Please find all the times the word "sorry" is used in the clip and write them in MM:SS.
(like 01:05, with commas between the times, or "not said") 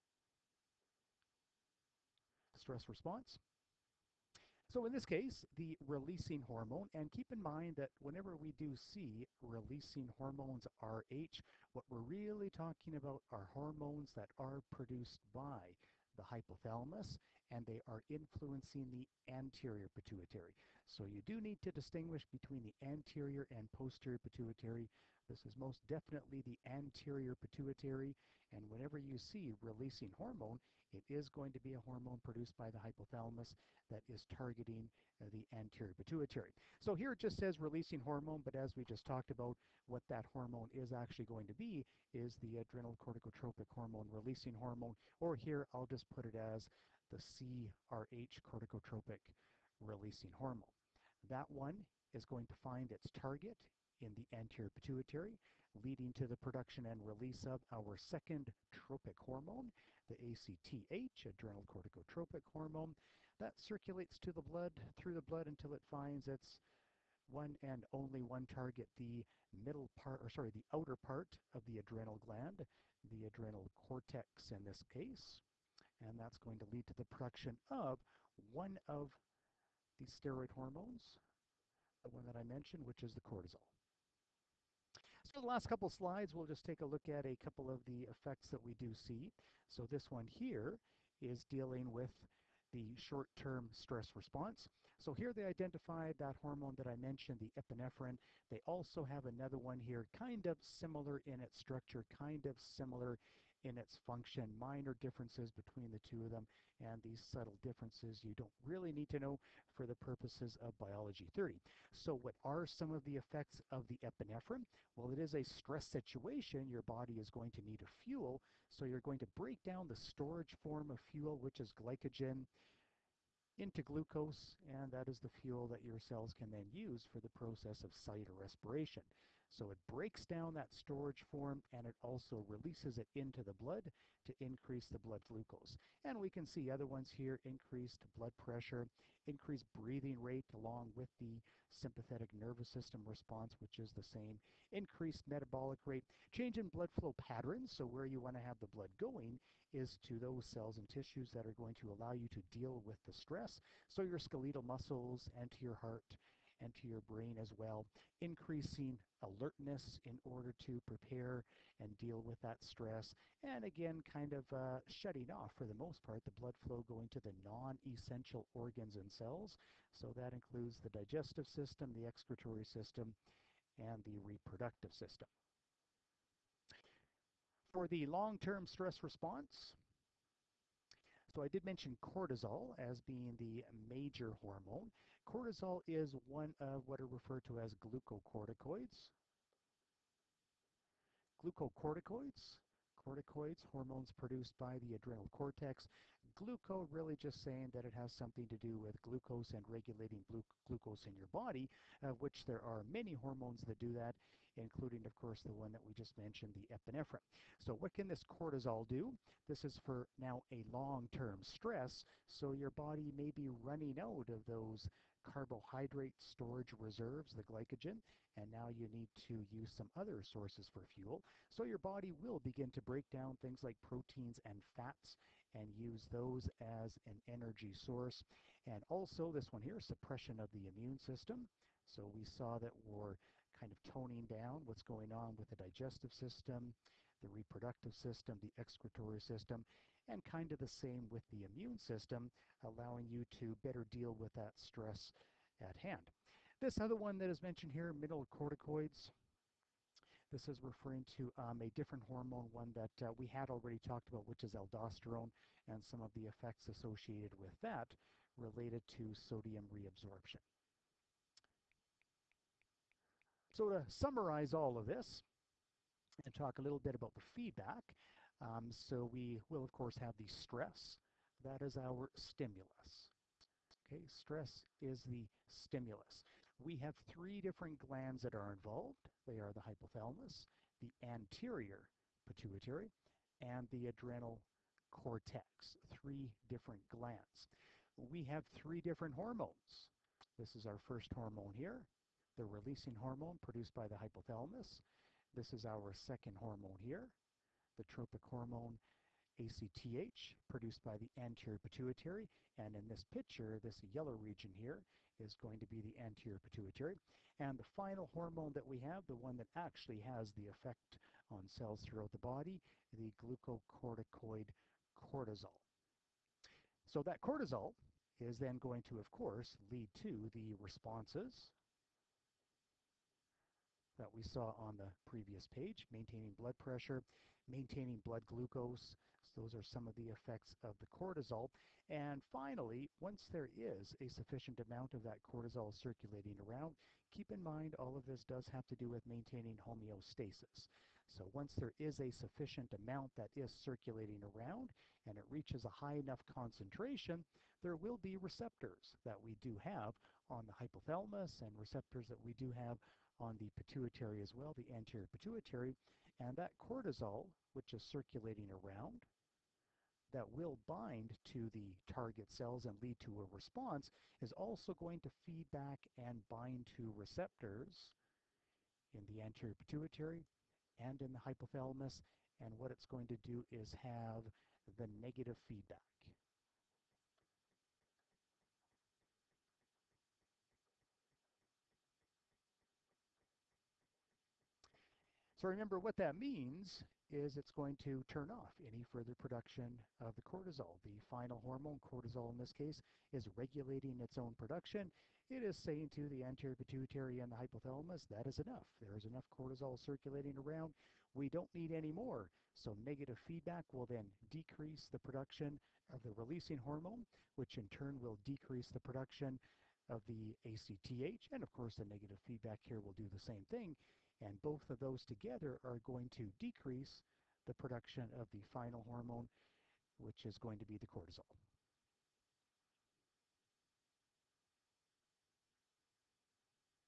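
01:10.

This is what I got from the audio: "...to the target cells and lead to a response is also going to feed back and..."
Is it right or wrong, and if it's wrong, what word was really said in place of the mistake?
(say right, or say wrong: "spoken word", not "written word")
right.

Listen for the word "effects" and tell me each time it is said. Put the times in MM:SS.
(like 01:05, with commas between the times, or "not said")
01:28, 01:53, 04:16, 05:10, 05:30.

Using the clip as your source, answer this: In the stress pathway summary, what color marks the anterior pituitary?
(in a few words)
yellow.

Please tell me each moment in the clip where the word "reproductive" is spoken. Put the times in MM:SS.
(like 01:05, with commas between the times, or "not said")
02:54, 03:57.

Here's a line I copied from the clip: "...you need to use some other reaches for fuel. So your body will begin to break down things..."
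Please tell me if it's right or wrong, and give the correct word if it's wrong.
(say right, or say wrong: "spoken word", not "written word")
wrong: "sources", not "reaches".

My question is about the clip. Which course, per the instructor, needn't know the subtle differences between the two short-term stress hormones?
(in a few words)
biology 30.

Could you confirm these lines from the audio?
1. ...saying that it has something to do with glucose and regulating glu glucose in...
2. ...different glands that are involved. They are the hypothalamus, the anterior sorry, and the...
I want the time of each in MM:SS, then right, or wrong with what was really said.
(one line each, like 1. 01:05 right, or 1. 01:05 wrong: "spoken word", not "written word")
1. 03:17 right
2. 04:37 wrong: "pituitary", not "sorry".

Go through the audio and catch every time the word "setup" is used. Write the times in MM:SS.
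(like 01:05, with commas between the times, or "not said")
not said.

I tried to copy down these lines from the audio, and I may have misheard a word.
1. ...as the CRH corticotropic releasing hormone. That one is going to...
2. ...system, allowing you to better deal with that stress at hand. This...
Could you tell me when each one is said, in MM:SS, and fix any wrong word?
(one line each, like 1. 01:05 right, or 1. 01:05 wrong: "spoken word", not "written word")
1. 00:46 right
2. 04:01 right.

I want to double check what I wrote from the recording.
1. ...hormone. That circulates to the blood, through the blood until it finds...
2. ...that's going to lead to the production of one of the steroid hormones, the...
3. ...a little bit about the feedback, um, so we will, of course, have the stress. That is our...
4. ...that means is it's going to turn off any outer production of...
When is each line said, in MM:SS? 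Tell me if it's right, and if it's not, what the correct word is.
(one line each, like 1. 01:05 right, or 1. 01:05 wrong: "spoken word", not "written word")
1. 01:02 right
2. 01:16 right
3. 04:26 right
4. 06:25 wrong: "further", not "outer".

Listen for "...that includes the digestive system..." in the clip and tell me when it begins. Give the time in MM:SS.
02:50.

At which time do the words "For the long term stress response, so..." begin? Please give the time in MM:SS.
02:57.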